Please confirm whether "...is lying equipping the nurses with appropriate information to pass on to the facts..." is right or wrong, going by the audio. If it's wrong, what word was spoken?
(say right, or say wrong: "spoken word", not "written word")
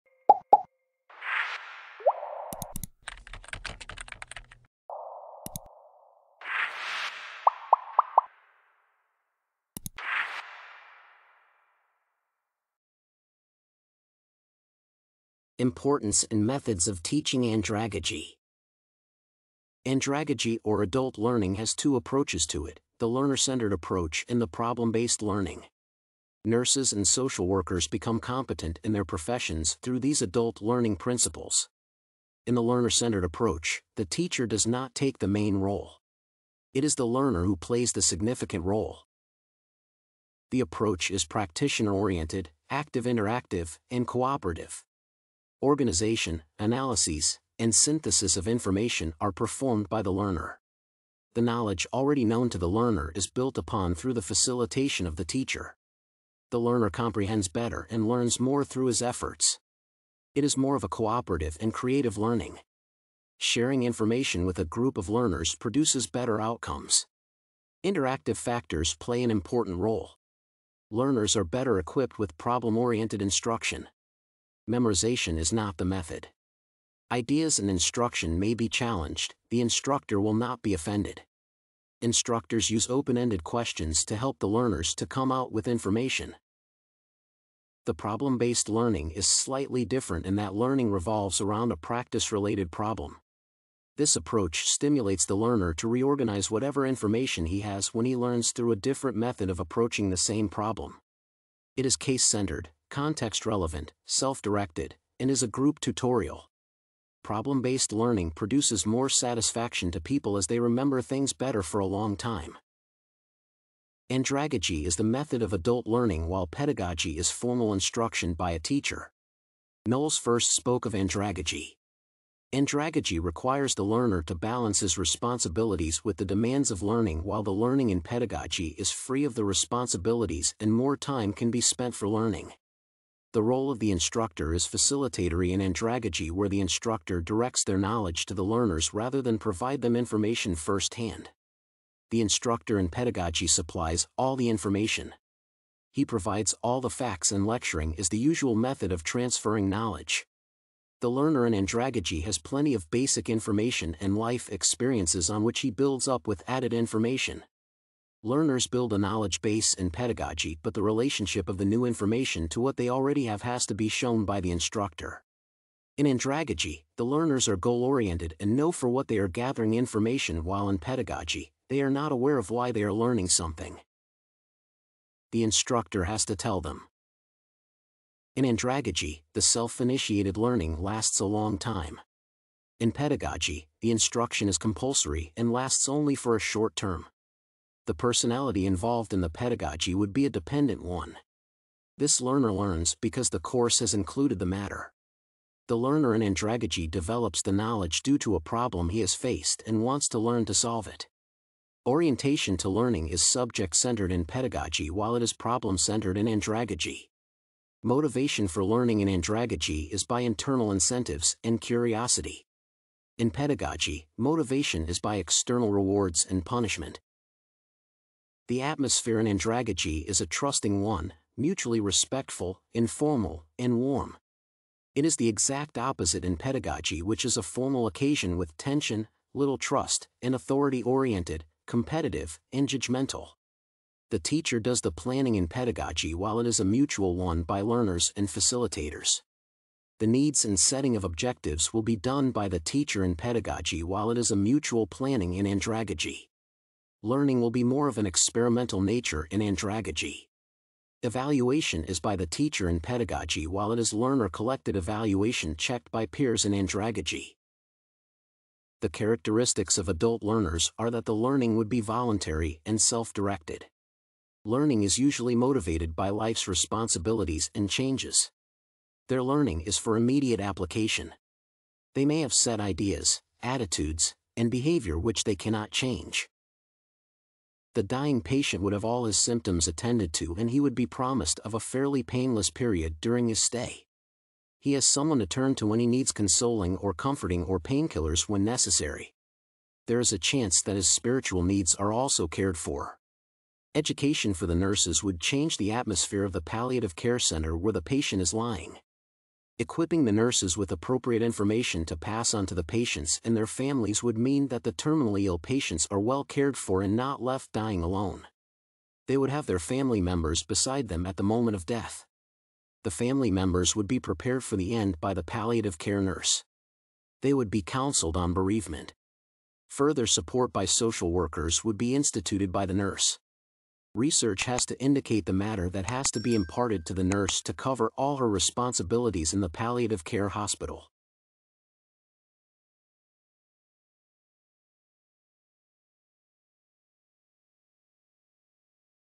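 wrong: "patients", not "facts".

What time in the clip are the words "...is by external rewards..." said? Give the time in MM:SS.
03:34.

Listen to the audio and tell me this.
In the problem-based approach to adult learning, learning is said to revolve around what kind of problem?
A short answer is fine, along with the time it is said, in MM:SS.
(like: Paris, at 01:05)
practice-related problem, at 01:31.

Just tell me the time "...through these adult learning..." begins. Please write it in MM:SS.
00:29.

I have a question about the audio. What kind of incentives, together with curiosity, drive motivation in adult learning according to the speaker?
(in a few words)
internal incentives.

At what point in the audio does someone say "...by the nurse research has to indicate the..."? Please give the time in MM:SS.
05:22.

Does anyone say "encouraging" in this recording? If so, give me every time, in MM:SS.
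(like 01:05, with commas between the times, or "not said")
not said.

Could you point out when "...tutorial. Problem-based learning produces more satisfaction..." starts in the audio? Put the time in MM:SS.
01:45.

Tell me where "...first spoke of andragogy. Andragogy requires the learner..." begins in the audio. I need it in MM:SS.
02:00.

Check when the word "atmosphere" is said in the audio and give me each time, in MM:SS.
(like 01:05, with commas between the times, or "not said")
03:38, 04:55.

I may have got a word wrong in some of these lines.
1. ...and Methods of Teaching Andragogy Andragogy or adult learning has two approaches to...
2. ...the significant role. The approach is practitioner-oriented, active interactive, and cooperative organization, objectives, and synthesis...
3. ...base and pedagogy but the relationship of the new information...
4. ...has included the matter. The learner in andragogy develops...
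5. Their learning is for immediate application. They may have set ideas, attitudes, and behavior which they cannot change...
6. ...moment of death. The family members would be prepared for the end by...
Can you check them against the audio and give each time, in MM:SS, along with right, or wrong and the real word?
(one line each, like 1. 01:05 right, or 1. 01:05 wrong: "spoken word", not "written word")
1. 00:16 right
2. 00:37 wrong: "analyses", not "objectives"
3. 02:39 right
4. 03:13 right
5. 04:29 right
6. 05:11 right.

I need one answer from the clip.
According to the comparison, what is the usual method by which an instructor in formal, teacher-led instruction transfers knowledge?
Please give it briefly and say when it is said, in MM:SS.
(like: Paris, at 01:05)
lecturing, at 02:27.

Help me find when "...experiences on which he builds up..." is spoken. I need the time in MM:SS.
02:34.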